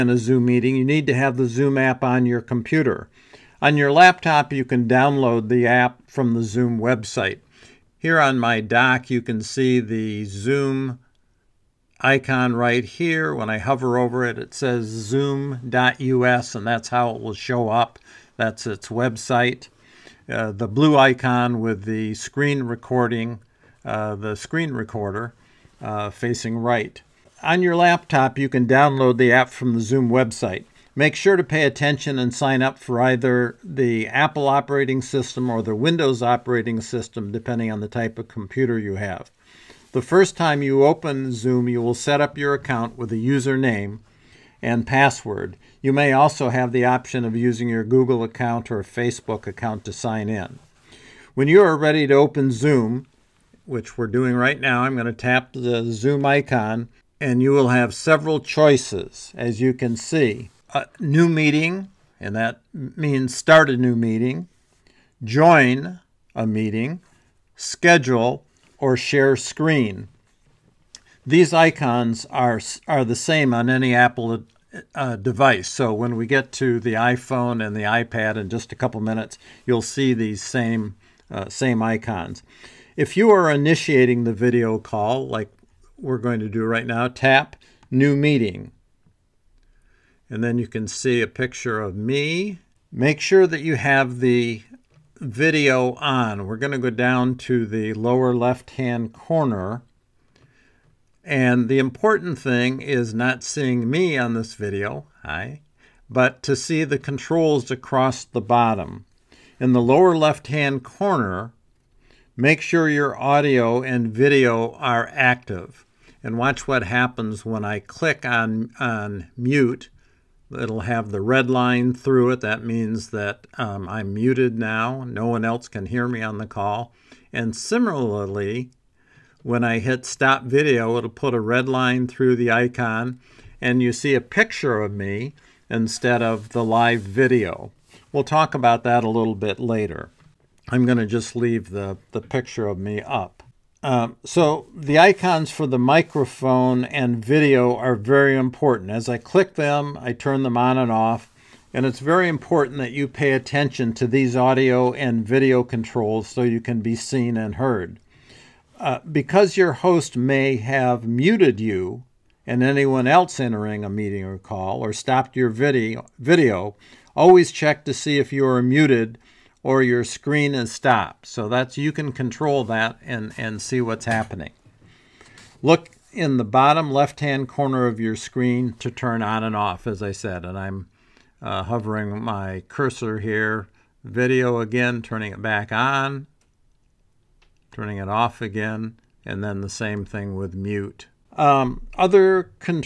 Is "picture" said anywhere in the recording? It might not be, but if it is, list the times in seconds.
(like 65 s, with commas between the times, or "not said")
91 s, 134 s, 142 s.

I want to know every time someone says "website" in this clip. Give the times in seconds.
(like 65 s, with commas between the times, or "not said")
6 s, 18 s, 30 s.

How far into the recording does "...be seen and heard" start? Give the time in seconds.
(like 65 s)
156 s.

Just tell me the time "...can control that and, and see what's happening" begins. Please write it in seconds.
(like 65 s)
171 s.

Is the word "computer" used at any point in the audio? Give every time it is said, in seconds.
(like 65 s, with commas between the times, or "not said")
2 s, 38 s.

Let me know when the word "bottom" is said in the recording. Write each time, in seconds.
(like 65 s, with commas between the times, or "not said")
108 s, 176 s.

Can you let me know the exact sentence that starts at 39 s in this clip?
The first time you open Zoom, you will set up your account with a username and password.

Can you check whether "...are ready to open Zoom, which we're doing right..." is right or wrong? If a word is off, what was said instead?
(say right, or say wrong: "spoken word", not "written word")
right.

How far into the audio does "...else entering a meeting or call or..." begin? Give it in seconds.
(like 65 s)
163 s.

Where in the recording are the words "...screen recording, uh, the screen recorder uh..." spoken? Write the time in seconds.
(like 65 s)
22 s.